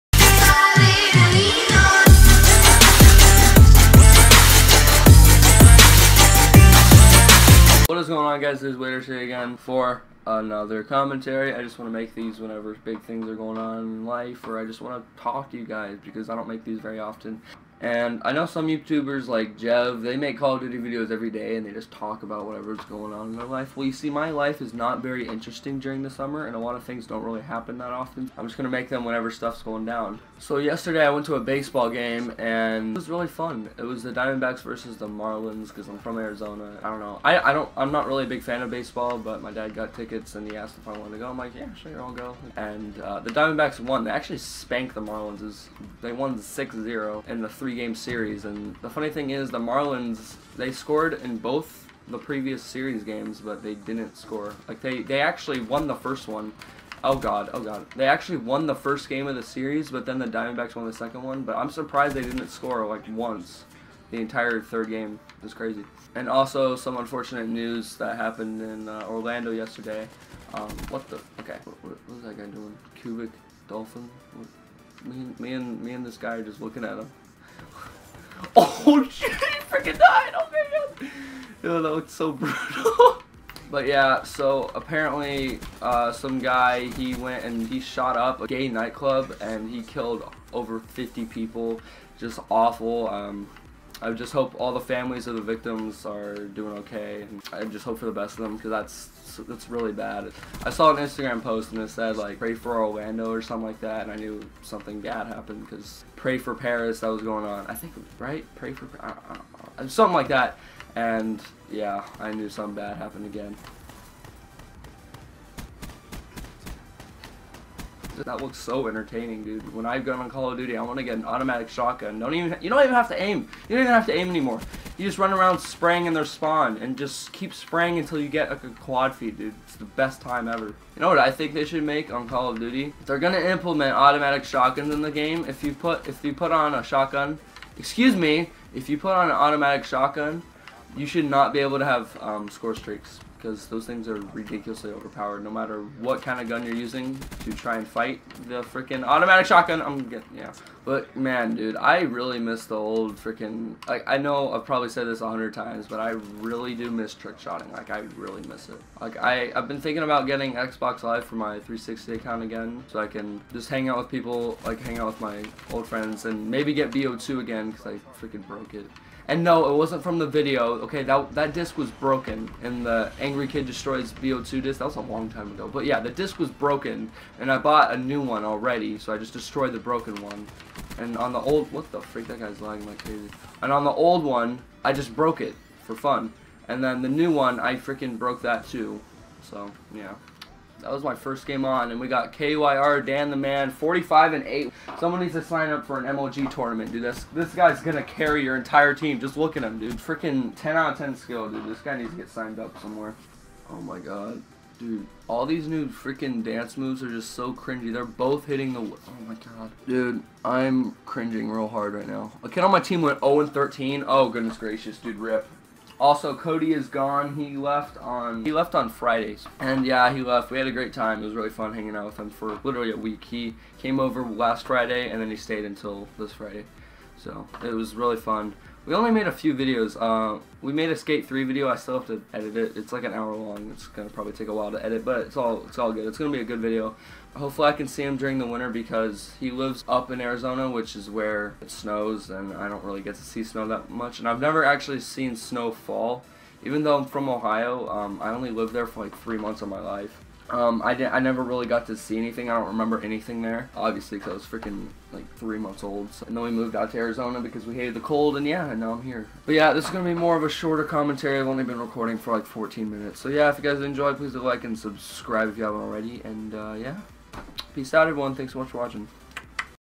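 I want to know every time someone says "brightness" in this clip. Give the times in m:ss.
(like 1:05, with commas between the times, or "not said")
not said.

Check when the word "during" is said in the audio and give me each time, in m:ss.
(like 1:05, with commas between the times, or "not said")
0:25, 3:58.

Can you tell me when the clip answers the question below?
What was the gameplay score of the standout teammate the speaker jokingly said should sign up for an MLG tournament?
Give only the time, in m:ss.
3:13.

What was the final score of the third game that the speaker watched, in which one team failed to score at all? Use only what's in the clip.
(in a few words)
6-0.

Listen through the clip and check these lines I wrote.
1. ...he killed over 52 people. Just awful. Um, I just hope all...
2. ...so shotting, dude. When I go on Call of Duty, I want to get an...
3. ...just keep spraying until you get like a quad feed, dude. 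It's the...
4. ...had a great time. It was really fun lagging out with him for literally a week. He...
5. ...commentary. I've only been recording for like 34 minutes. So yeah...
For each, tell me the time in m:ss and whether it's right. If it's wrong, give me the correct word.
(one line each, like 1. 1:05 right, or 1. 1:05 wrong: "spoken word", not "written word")
1. 1:29 wrong: "50", not "52"
2. 1:58 wrong: "entertaining", not "shotting"
3. 2:06 right
4. 3:40 wrong: "hanging", not "lagging"
5. 4:20 wrong: "14", not "34".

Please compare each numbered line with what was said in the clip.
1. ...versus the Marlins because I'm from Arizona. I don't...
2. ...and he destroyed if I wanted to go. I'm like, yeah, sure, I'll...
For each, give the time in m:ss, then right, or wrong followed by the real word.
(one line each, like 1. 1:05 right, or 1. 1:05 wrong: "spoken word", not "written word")
1. 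0:34 right
2. 0:40 wrong: "asked", not "destroyed".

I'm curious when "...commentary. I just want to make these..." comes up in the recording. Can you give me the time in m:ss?
0:10.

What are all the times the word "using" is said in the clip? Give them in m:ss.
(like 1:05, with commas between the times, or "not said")
2:26.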